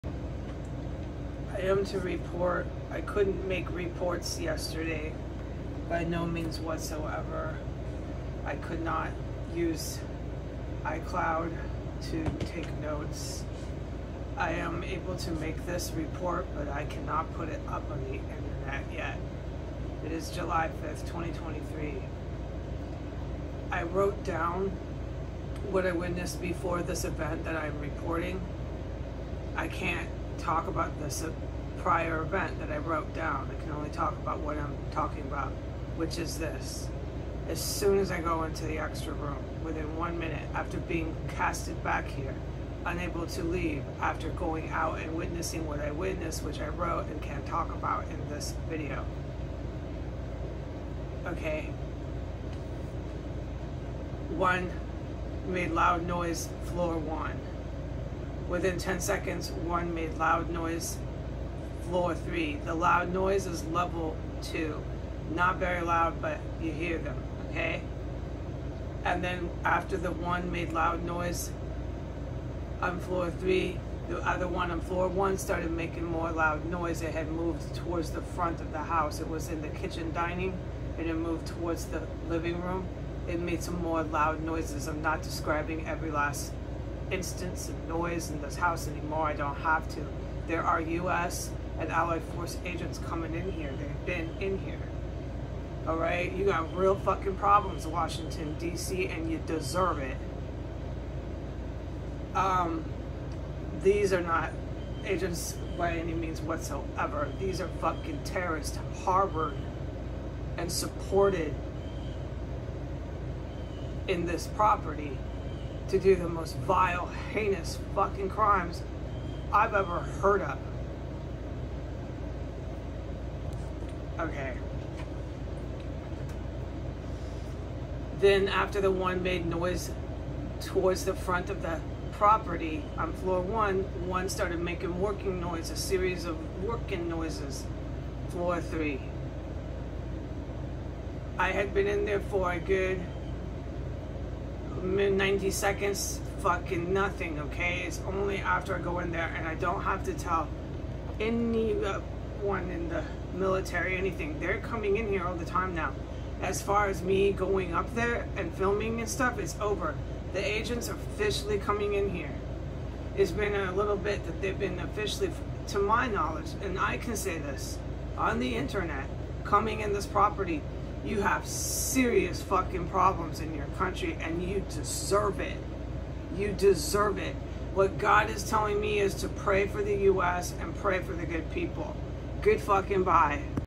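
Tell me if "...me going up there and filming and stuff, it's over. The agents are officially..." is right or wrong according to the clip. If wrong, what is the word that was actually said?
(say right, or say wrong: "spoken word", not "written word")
right.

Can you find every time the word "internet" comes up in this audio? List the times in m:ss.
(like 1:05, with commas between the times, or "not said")
0:18, 2:48.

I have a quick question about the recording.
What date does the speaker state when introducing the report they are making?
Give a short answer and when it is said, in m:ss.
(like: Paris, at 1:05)
July 5, 2023, at 0:20.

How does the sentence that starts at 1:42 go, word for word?
Um, these are not agents by any means whatsoever.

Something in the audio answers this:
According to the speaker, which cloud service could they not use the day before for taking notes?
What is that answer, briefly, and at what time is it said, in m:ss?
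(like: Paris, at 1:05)
iCloud, at 0:10.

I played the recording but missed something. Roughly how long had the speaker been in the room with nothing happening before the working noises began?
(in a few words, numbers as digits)
90 seconds.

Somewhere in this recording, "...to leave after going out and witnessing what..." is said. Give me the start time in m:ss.
0:43.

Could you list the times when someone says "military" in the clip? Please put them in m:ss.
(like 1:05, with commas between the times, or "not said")
2:33.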